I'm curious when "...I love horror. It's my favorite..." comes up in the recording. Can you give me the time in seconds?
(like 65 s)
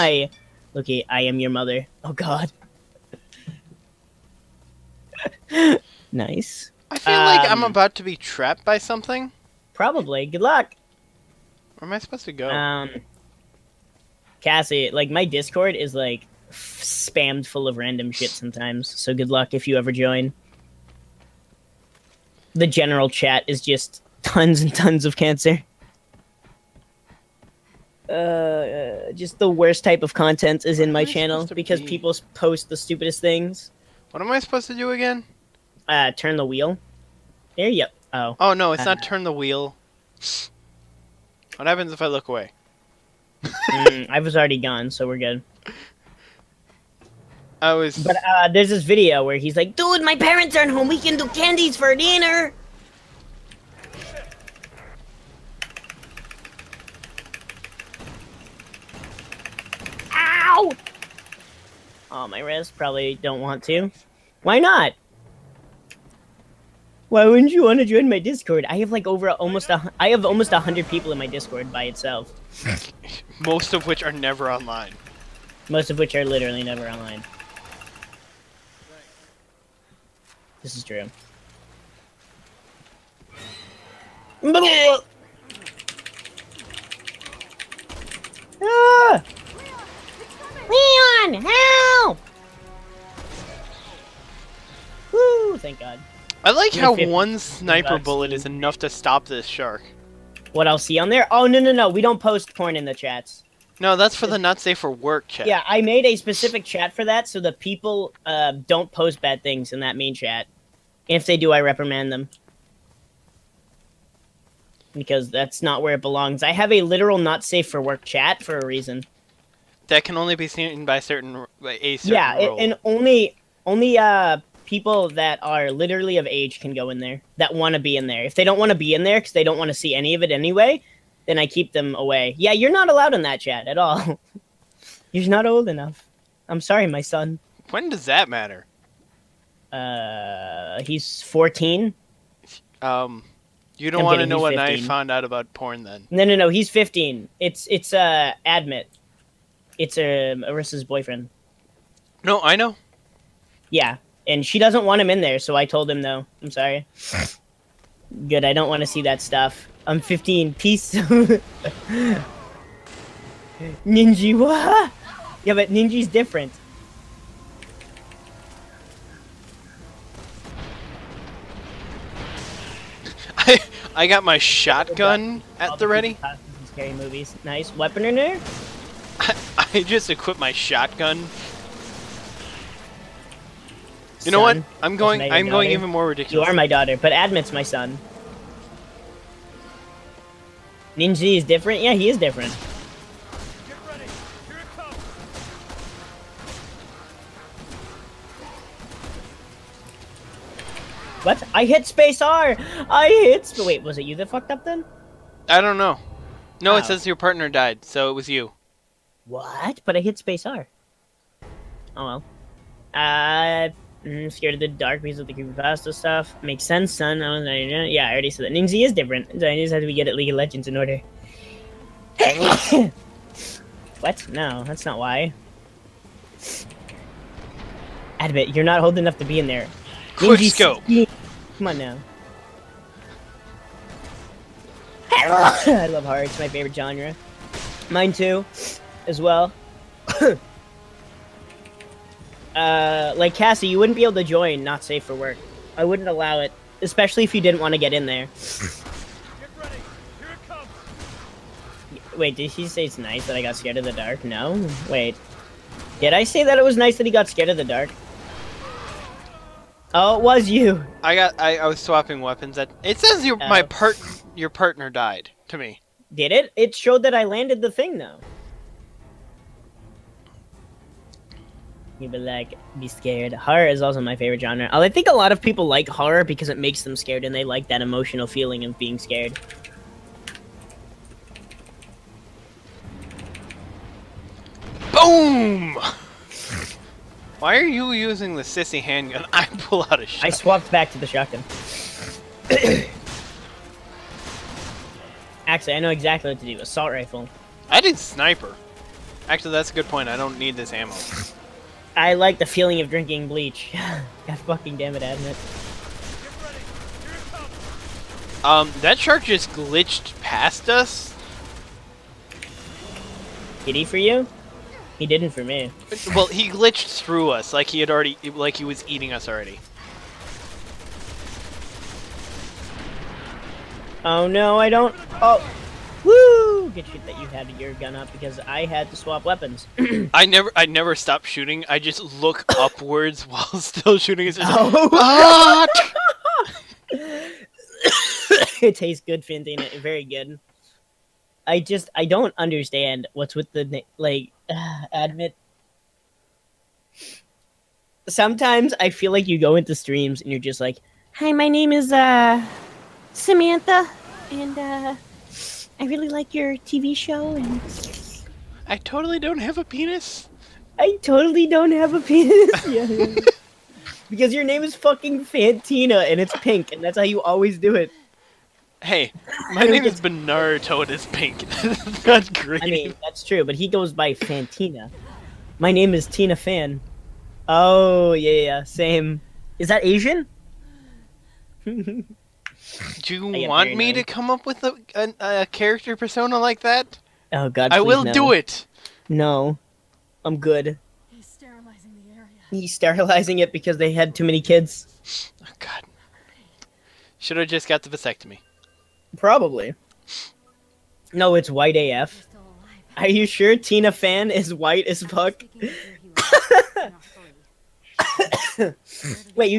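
235 s.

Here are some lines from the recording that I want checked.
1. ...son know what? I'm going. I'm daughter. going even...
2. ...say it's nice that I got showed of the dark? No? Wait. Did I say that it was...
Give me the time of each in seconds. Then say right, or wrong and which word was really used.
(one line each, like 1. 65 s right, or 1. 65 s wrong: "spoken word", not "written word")
1. 184 s right
2. 252 s wrong: "scared", not "showed".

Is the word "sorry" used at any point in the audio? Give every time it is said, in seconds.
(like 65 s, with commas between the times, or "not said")
136 s, 156 s.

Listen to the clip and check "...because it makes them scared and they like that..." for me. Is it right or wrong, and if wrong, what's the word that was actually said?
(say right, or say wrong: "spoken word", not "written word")
right.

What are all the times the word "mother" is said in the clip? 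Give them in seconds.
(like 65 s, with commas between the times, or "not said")
1 s.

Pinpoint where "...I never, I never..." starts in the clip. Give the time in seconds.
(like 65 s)
330 s.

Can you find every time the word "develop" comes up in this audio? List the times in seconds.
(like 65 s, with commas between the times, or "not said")
not said.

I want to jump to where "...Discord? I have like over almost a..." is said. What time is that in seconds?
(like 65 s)
68 s.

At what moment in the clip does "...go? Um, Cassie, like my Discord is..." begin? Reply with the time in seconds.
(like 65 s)
12 s.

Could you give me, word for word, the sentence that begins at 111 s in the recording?
And if they do, I reprimand them.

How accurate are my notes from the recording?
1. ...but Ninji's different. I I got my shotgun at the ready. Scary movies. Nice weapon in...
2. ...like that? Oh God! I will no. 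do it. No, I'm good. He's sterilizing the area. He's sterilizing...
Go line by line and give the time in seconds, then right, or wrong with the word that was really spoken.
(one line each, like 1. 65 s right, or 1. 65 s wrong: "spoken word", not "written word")
1. 165 s right
2. 386 s right.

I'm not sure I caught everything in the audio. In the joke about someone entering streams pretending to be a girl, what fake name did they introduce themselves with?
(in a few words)
Samantha.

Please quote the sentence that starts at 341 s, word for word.
I just, I don't understand what's with the like.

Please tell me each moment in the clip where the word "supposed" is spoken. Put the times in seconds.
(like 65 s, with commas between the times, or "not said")
11 s, 34 s.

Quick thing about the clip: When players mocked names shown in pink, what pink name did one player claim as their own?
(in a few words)
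Bonaruto.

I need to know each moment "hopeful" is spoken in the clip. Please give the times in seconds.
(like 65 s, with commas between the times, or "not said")
not said.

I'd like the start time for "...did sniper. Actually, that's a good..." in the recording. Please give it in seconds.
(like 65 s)
297 s.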